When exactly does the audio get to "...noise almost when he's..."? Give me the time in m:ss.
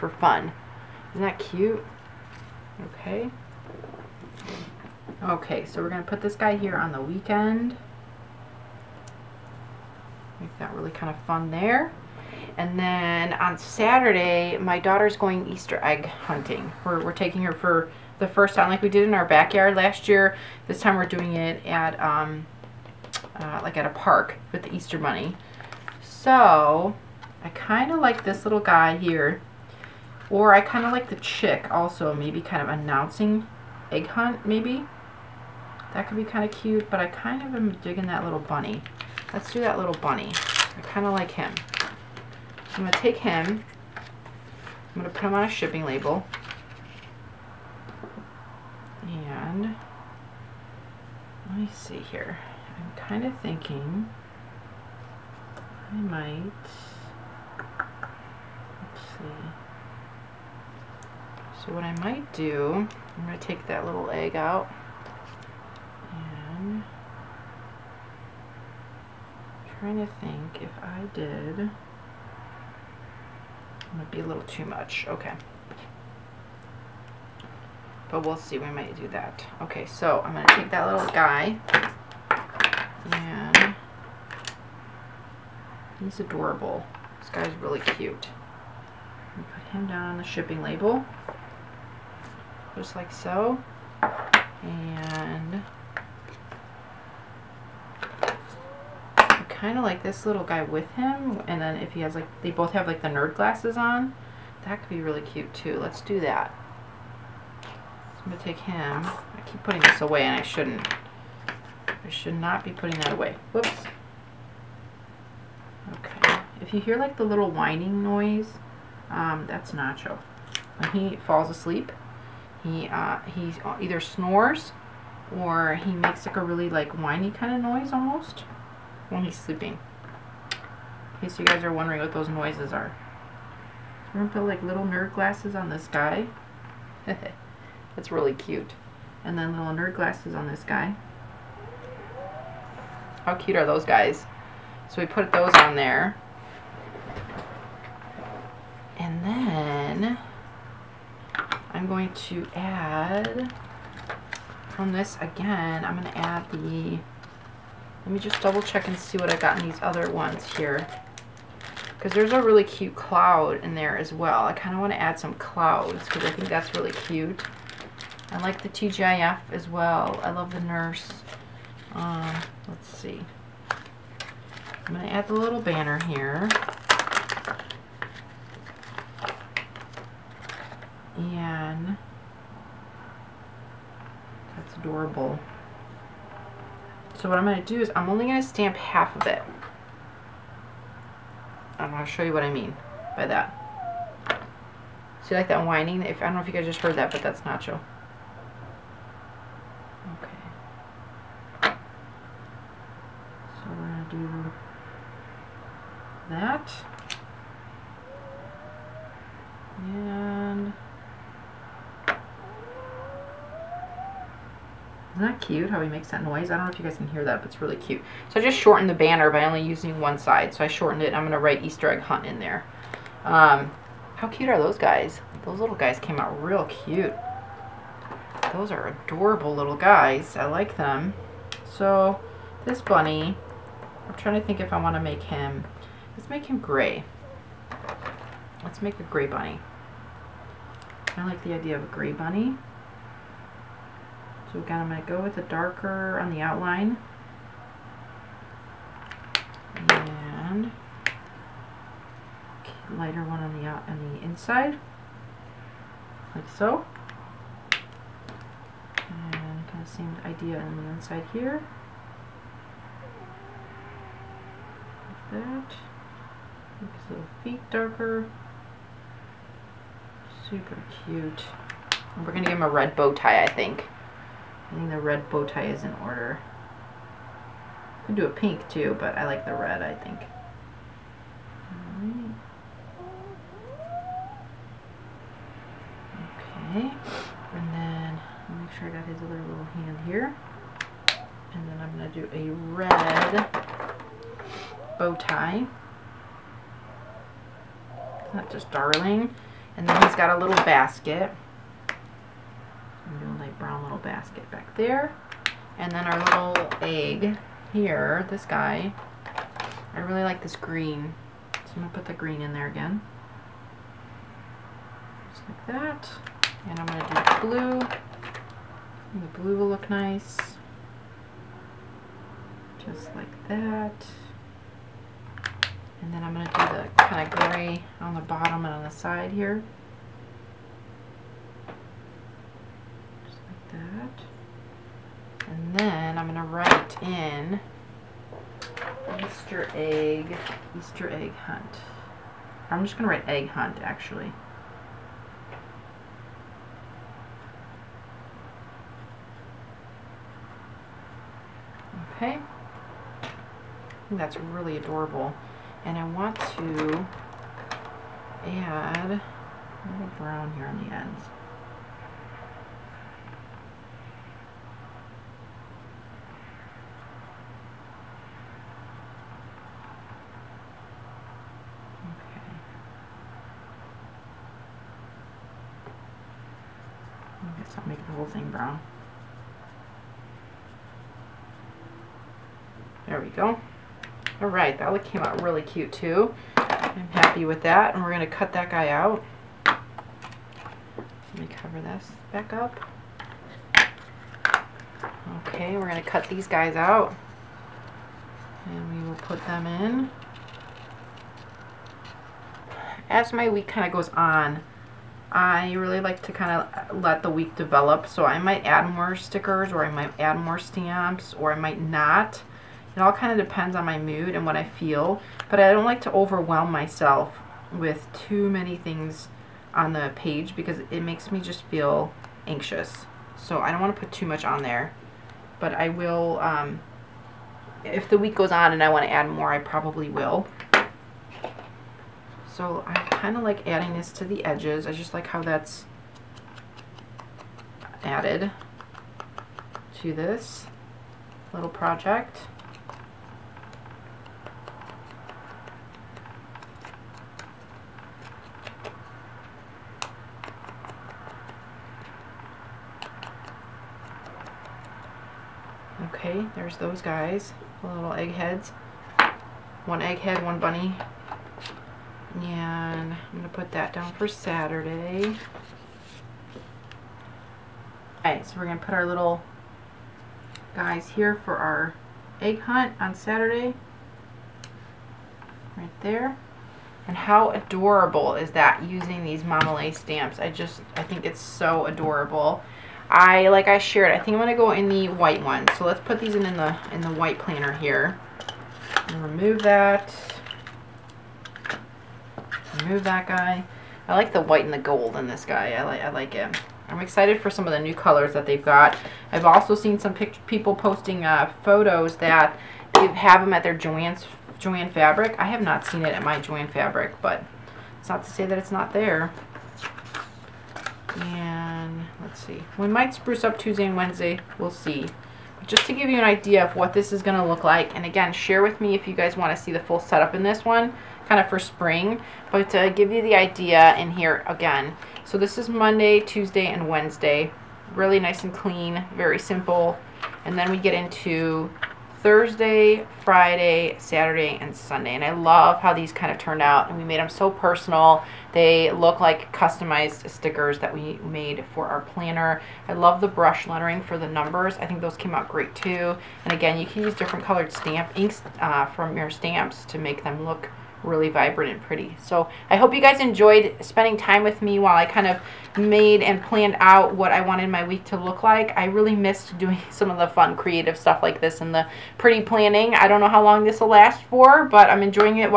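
2:07.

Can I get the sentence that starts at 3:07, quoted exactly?
So what I'm going to do is I'm only going to stamp half of it.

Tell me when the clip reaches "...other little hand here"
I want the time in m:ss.
4:49.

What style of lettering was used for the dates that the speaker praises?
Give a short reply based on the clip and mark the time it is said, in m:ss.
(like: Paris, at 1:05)
Brush lettering, at 9:03.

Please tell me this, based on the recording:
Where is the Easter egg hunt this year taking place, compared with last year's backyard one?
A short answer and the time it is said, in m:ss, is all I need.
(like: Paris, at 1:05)
A park, at 0:23.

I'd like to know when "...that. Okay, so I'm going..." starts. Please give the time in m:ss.
1:19.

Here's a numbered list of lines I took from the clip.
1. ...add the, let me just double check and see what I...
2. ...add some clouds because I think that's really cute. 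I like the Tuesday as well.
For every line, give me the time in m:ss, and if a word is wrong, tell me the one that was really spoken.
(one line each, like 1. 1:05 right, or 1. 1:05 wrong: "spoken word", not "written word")
1. 2:36 right
2. 2:45 wrong: "TGIF", not "Tuesday".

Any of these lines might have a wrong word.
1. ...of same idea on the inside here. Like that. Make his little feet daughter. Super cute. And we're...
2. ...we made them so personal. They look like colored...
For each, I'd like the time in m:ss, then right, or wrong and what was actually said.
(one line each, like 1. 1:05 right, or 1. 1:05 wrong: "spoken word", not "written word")
1. 4:19 wrong: "darker", not "daughter"
2. 8:56 wrong: "customized", not "colored".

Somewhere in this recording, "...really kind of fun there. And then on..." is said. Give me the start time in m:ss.
0:10.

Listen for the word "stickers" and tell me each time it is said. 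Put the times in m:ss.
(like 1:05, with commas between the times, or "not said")
6:49, 9:00.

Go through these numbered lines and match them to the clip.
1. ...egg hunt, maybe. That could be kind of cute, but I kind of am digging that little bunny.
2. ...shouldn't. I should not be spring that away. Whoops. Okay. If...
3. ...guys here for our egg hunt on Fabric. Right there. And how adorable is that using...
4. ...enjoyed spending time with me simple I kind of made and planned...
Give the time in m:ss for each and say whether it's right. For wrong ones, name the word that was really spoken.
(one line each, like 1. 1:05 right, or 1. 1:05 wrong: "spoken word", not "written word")
1. 0:33 right
2. 1:50 wrong: "putting", not "spring"
3. 7:50 wrong: "Saturday", not "Fabric"
4. 9:13 wrong: "while", not "simple".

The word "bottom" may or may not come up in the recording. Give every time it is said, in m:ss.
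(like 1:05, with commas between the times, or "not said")
5:28.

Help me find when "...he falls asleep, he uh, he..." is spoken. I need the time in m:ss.
2:00.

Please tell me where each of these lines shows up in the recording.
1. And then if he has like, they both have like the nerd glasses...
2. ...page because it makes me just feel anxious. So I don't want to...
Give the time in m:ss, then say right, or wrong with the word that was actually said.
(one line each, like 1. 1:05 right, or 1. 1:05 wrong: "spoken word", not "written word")
1. 1:41 right
2. 7:00 right.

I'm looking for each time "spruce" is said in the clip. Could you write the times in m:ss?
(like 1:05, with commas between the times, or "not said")
8:33.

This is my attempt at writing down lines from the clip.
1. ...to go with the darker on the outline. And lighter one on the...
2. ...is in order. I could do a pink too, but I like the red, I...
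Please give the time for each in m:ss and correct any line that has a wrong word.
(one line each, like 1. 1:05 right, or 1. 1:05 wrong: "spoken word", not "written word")
1. 4:05 right
2. 4:35 right.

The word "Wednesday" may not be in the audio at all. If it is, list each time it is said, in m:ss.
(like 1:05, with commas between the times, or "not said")
8:33, 8:46.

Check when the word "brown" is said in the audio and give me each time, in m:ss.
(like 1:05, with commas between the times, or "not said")
6:00, 6:18.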